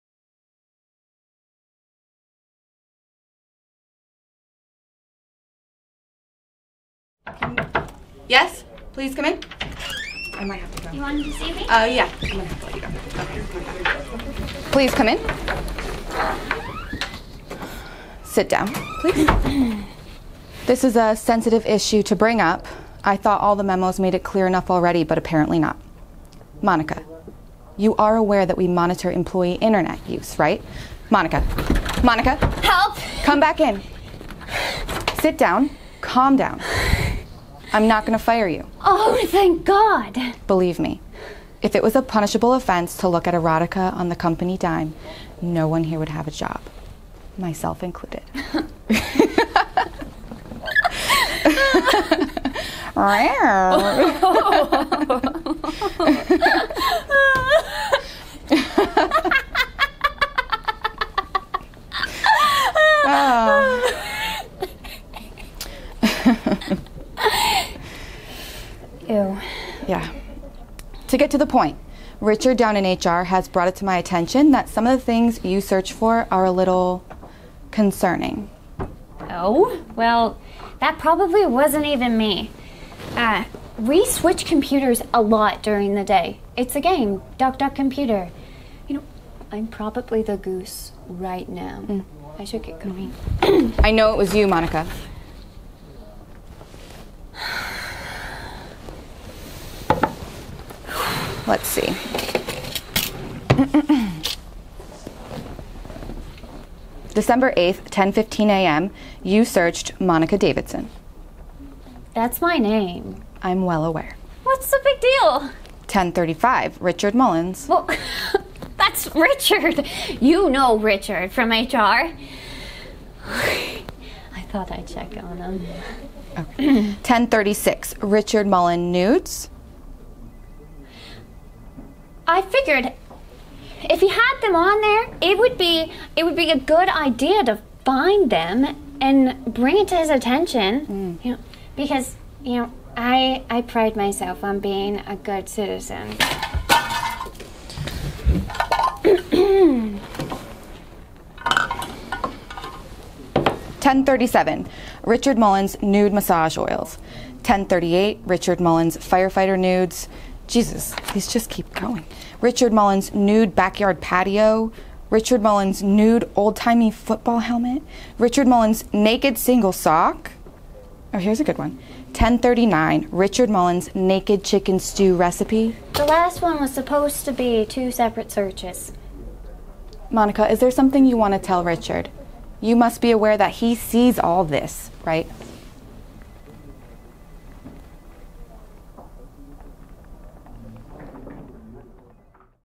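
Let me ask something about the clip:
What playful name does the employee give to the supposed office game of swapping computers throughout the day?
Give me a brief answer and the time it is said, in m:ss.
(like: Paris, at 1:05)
Duck Duck Computer, at 1:27.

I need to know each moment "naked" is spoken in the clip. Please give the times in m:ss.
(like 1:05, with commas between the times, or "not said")
2:48, 2:53.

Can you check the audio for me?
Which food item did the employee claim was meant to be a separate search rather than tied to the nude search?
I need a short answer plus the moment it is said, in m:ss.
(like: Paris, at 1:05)
chicken stew recipe, at 2:54.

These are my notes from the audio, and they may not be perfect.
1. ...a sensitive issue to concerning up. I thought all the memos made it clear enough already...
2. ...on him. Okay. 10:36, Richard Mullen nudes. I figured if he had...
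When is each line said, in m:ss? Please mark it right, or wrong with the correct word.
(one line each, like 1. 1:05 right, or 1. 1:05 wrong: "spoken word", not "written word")
1. 0:20 wrong: "bring", not "concerning"
2. 2:05 right.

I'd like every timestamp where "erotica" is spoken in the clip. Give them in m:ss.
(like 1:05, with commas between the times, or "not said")
0:43.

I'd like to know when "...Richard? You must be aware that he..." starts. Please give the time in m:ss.
3:01.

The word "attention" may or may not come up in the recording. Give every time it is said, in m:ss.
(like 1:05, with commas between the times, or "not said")
1:13, 2:20.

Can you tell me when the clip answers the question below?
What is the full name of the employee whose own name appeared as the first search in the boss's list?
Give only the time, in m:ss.
1:49.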